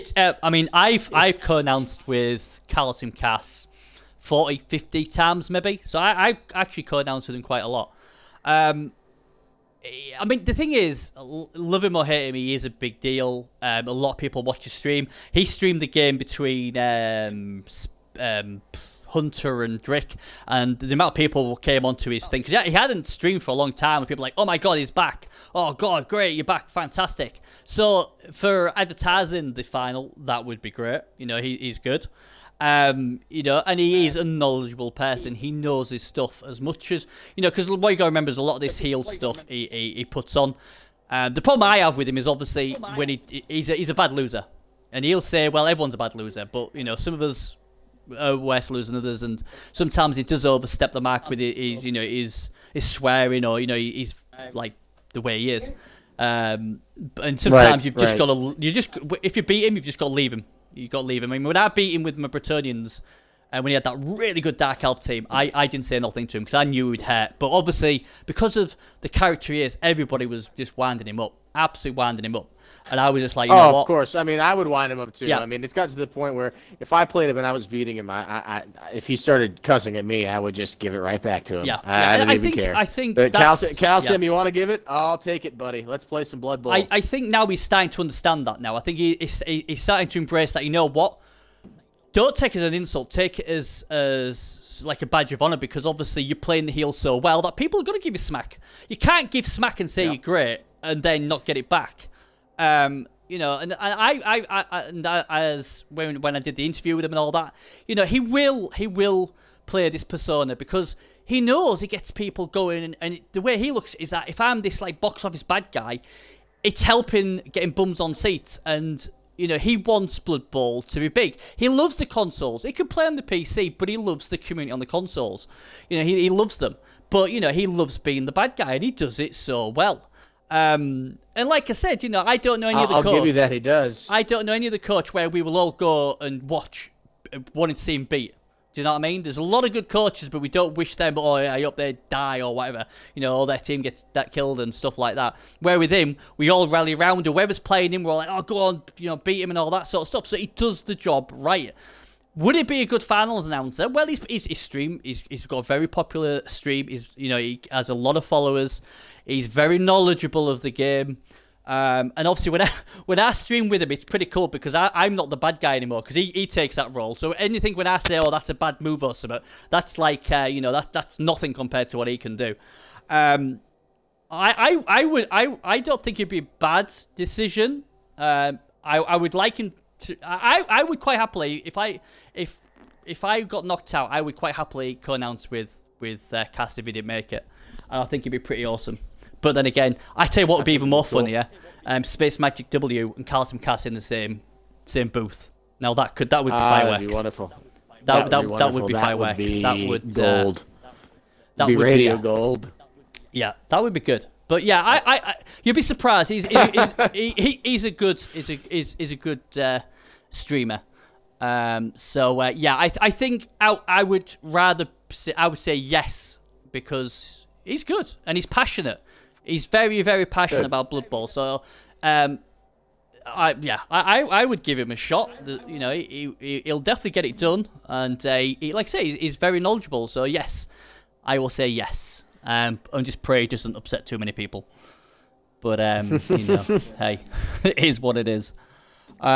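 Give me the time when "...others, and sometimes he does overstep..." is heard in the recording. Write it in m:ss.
0:48.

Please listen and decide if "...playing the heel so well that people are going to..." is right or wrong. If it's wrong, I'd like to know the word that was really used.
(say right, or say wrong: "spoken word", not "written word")
right.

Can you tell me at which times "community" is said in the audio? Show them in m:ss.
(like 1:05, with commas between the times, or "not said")
2:04.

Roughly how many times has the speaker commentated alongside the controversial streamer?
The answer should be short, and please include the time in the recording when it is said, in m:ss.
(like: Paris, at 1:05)
40 to 50, at 0:04.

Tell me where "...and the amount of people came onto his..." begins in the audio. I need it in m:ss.
0:20.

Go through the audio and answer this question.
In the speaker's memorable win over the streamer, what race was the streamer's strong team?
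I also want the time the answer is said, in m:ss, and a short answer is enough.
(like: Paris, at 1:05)
Dark Elf, at 1:04.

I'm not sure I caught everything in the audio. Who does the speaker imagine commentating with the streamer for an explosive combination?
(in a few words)
Space Magic W.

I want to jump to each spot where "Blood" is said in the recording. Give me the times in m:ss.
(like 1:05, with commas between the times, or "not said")
1:26, 2:00, 3:40.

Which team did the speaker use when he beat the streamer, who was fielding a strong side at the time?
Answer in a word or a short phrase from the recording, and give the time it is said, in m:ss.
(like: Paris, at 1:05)
Bretonnians, at 1:02.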